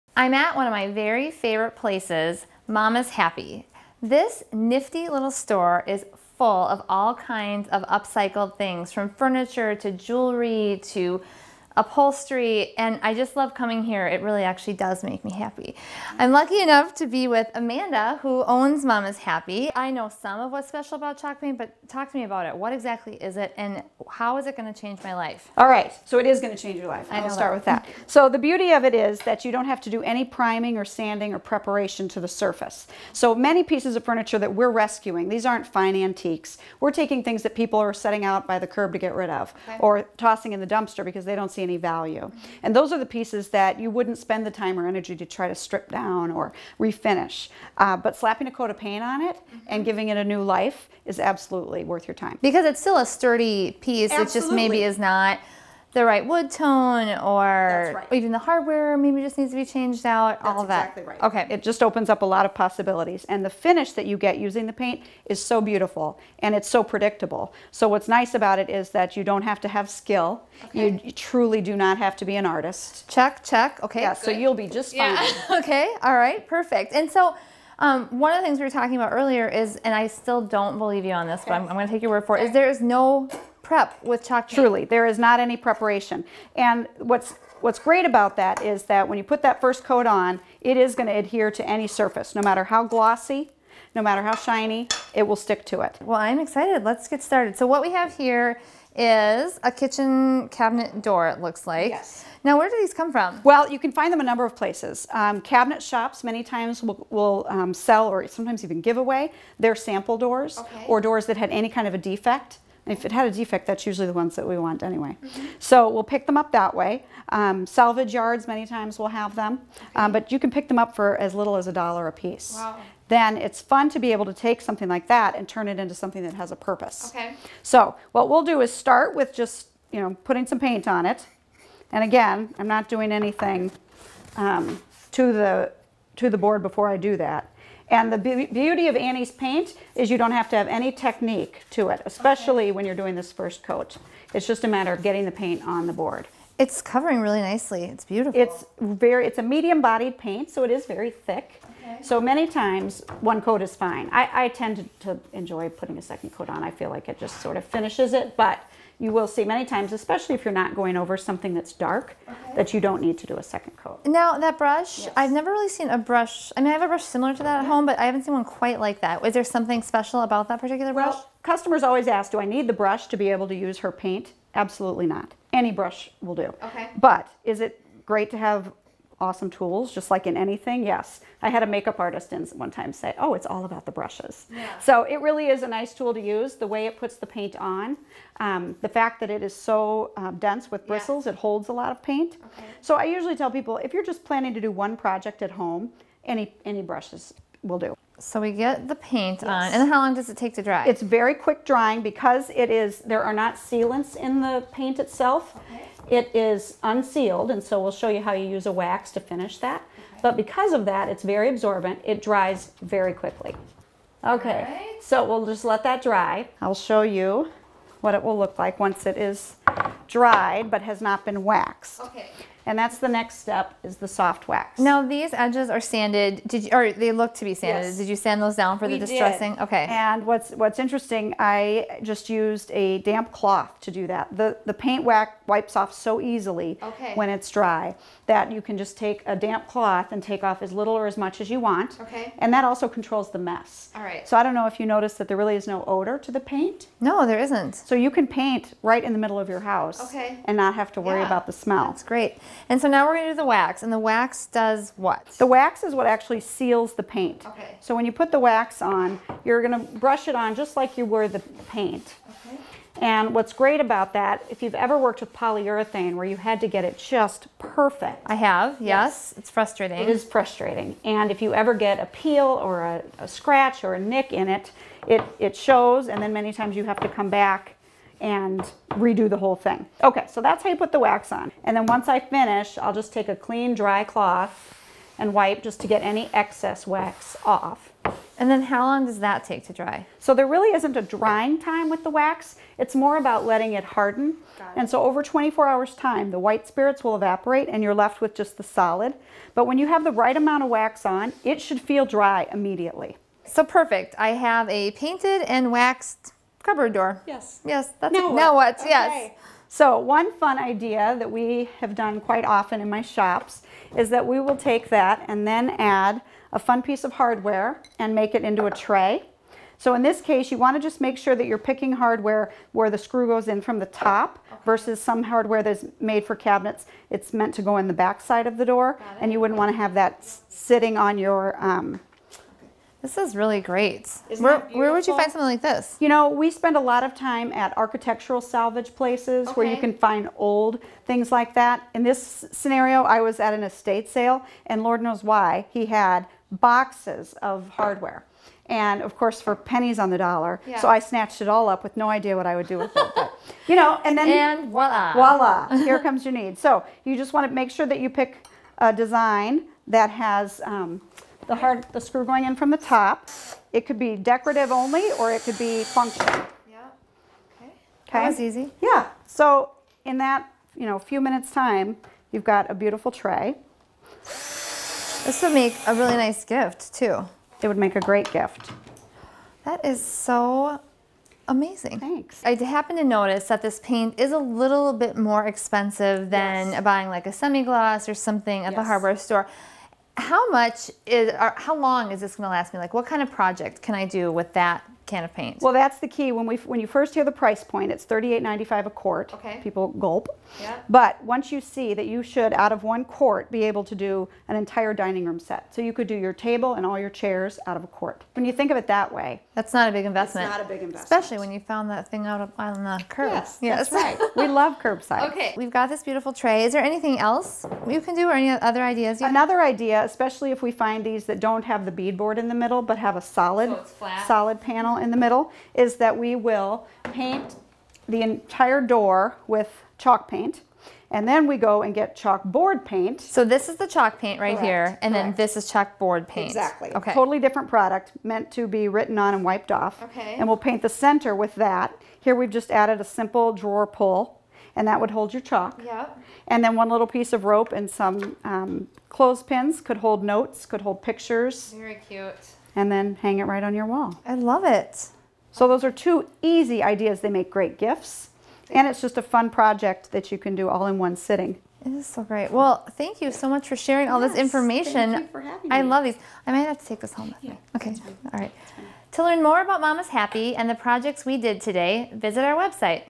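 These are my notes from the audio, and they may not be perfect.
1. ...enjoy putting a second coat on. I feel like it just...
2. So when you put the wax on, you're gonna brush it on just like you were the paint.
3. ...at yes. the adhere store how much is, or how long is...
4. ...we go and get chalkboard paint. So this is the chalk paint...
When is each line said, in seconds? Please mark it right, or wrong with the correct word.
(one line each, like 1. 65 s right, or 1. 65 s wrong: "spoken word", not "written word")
1. 155 s right
2. 257 s right
3. 388 s wrong: "hardware", not "adhere"
4. 431 s right.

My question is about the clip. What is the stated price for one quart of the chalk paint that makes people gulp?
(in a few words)
$38.95.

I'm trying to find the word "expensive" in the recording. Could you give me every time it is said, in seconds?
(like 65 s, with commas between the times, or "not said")
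385 s.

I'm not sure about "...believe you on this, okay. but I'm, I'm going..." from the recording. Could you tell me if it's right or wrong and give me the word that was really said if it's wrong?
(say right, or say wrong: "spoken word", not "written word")
right.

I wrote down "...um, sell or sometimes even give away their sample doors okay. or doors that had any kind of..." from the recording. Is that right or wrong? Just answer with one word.
right.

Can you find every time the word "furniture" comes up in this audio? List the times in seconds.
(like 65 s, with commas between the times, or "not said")
9 s, 34 s.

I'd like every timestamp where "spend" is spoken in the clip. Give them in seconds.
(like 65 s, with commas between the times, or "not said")
44 s, 336 s.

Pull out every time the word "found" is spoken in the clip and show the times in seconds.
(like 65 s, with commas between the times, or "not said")
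411 s.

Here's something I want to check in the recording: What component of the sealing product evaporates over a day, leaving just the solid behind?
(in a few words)
white spirits.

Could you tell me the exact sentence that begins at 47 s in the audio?
Uh, but slapping a coat of paint on it and mm-hmm.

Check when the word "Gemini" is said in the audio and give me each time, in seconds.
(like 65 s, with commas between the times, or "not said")
not said.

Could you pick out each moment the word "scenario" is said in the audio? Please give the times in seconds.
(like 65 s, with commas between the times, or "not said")
342 s.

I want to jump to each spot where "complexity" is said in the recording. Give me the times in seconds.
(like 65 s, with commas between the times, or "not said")
not said.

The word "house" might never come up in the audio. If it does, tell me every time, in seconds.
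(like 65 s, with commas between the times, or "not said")
249 s.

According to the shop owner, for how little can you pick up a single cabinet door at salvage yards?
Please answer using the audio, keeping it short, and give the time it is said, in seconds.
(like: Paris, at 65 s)
a dollar, at 121 s.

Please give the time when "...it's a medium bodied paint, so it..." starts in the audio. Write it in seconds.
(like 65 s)
149 s.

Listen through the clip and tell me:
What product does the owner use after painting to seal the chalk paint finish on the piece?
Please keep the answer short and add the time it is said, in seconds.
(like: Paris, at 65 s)
soft wax, at 224 s.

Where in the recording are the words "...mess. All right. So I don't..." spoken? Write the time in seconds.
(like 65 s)
243 s.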